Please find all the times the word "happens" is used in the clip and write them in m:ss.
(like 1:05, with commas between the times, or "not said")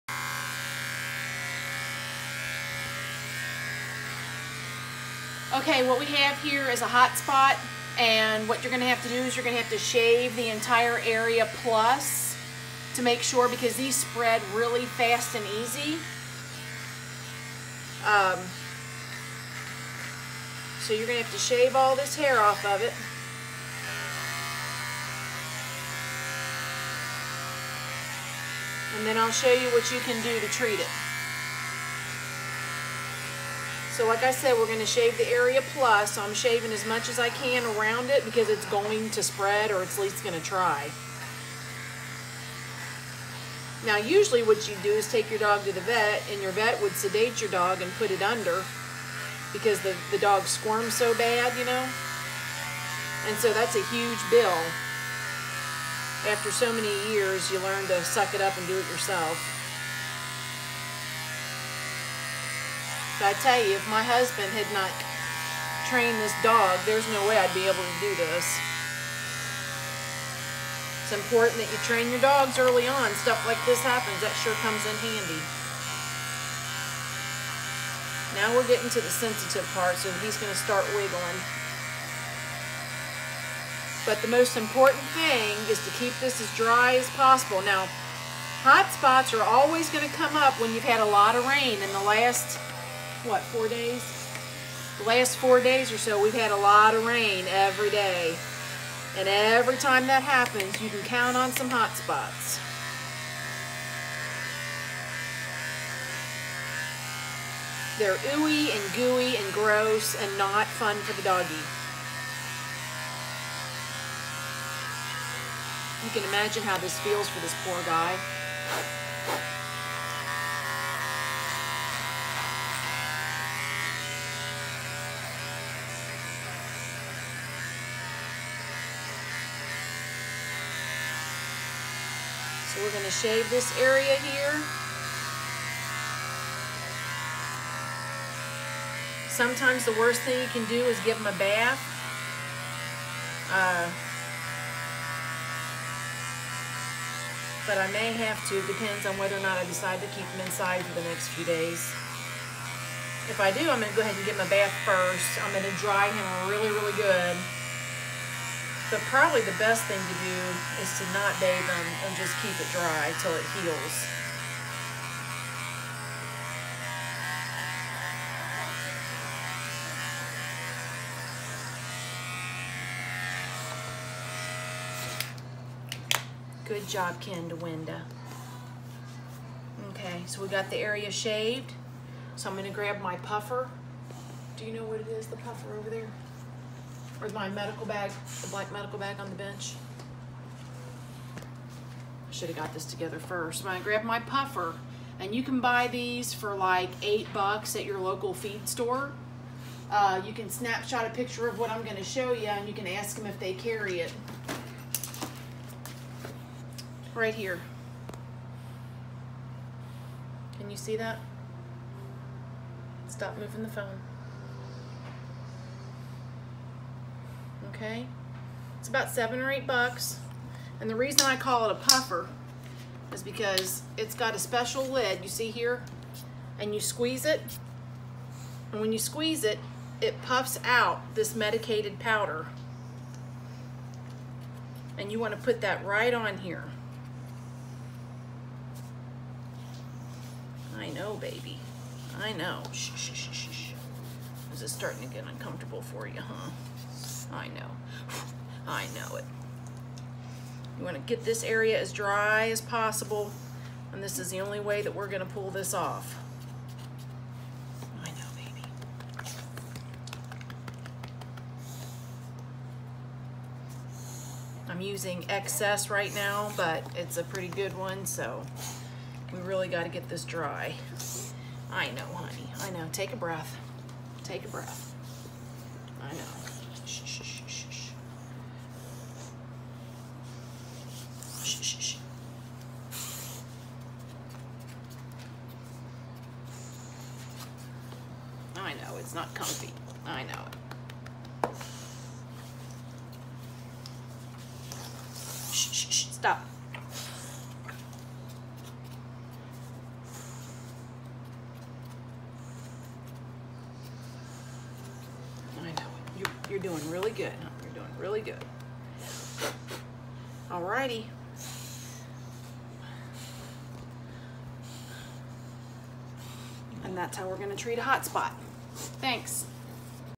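1:13, 1:40.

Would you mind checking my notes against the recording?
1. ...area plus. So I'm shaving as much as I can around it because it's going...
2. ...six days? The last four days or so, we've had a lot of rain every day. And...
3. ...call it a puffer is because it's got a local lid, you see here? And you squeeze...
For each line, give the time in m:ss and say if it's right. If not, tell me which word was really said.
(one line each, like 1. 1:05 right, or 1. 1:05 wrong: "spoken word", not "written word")
1. 0:35 right
2. 1:33 wrong: "four", not "six"
3. 3:41 wrong: "special", not "local".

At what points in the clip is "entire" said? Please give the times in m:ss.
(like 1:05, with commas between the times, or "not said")
0:10.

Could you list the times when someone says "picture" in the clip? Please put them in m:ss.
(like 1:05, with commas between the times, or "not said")
3:21.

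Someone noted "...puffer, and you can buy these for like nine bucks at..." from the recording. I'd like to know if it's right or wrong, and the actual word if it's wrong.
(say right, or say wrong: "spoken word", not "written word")
wrong: "eight", not "nine".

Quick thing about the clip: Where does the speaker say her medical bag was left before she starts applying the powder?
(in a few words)
on the bench.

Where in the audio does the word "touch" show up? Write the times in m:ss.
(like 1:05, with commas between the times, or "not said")
not said.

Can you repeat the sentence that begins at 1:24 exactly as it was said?
But the most important thing is to keep this as dry as possible.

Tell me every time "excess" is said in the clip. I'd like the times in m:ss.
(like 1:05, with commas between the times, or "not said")
4:25.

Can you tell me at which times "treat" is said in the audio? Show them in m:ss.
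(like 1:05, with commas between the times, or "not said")
0:30, 5:17.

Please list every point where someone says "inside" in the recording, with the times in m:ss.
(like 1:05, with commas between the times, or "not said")
2:30.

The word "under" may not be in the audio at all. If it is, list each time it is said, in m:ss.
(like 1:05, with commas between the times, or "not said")
0:48.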